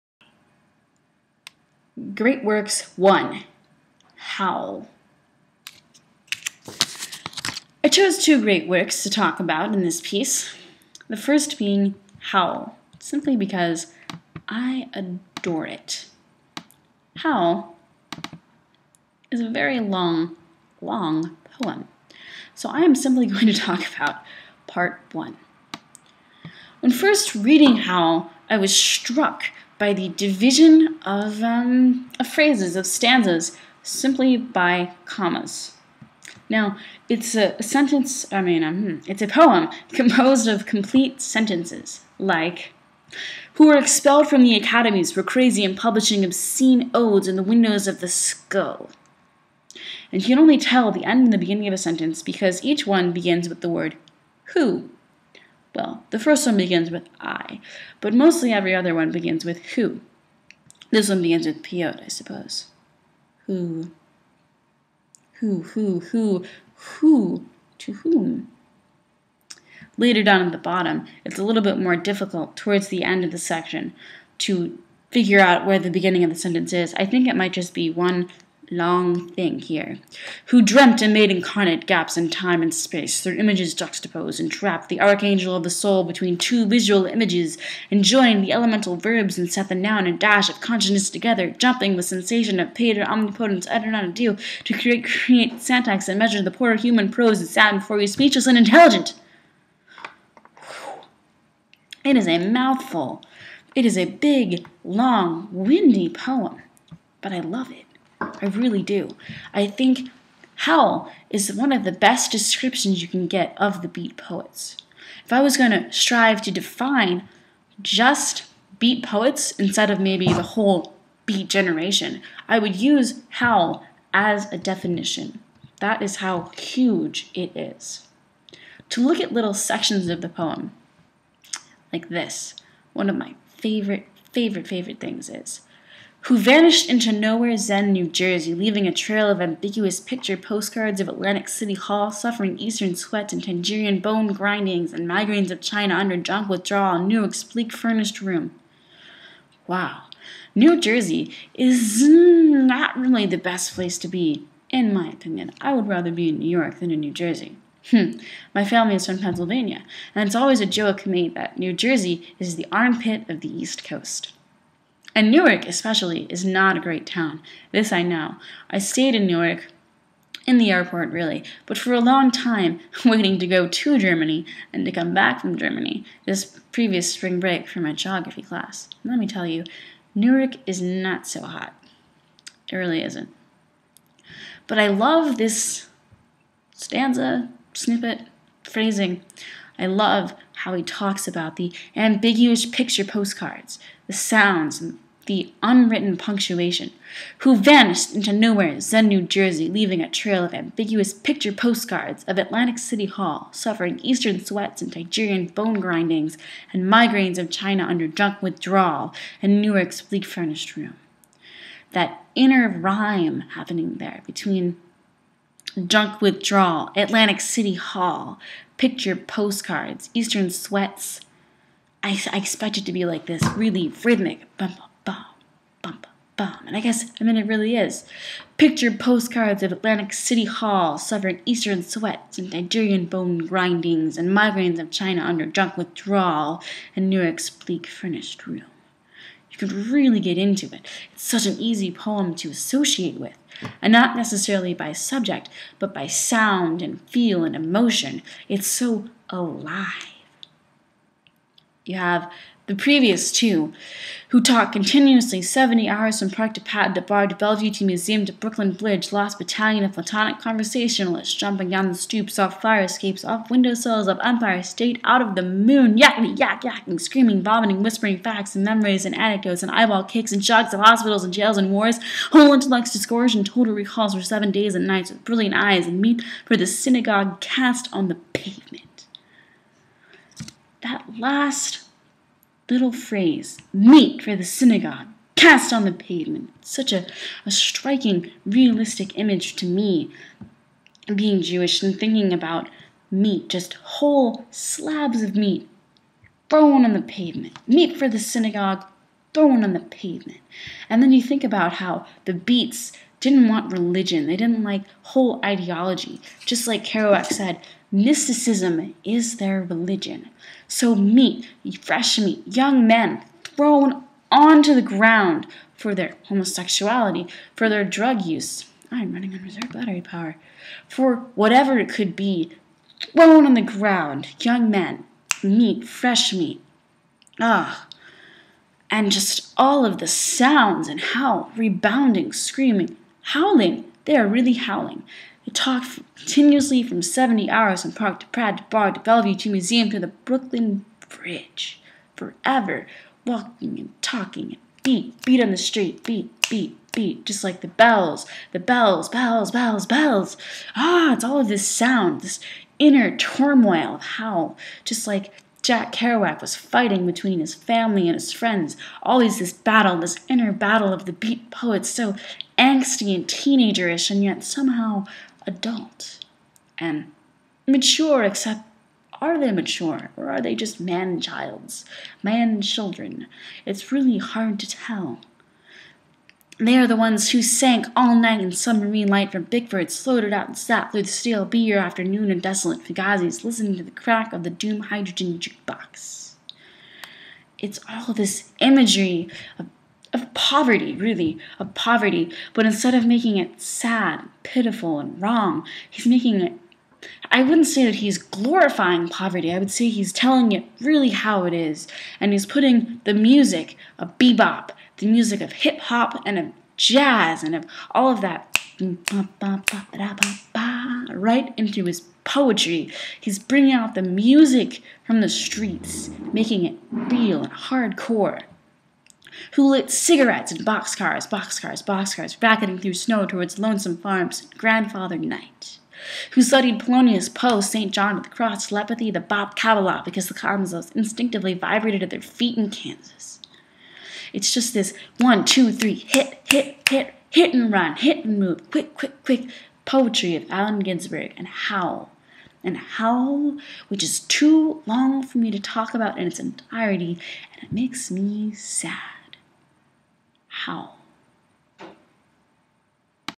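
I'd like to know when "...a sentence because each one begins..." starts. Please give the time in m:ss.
0:51.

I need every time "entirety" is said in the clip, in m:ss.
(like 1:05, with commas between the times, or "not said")
7:26.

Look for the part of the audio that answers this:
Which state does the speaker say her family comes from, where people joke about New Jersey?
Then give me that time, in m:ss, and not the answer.
2:39.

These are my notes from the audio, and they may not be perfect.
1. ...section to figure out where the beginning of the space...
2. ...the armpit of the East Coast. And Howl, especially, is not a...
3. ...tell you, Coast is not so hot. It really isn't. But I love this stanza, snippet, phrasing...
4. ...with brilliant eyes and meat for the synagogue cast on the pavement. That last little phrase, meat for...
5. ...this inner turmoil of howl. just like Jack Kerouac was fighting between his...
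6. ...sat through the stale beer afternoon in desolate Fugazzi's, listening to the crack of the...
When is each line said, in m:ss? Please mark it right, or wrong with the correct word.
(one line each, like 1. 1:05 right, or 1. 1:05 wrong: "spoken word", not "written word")
1. 1:13 wrong: "sentence", not "space"
2. 2:42 wrong: "Newark", not "Howl"
3. 2:59 wrong: "Newark", not "Coast"
4. 4:35 right
5. 5:52 right
6. 6:20 right.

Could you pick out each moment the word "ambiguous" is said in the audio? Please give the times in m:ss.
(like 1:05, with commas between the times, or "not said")
2:19, 3:11, 3:20.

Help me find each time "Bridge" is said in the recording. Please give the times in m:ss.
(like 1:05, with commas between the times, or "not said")
4:18, 5:41.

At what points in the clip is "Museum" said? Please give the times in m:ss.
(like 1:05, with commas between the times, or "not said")
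4:17, 5:39.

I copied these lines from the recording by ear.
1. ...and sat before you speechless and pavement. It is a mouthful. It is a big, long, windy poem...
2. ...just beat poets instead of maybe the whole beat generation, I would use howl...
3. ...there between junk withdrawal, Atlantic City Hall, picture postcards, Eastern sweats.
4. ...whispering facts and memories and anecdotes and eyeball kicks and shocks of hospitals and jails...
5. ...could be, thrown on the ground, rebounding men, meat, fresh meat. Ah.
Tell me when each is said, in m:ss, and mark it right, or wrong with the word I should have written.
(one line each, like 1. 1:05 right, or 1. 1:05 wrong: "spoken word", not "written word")
1. 1:37 wrong: "intelligent", not "pavement"
2. 1:57 right
3. 3:33 right
4. 4:27 right
5. 5:21 wrong: "young", not "rebounding".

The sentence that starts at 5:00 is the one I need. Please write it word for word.
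And then you think about how the Beats didn't want religion, they didn't like whole ideology.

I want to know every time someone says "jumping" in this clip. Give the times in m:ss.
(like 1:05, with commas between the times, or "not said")
1:31, 4:21.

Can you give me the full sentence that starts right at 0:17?
Howl is a very long, long poem.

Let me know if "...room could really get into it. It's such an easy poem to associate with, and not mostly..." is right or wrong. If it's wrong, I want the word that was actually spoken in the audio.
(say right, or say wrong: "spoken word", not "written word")
wrong: "necessarily", not "mostly".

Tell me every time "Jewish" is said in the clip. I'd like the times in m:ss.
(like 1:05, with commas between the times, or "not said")
4:51.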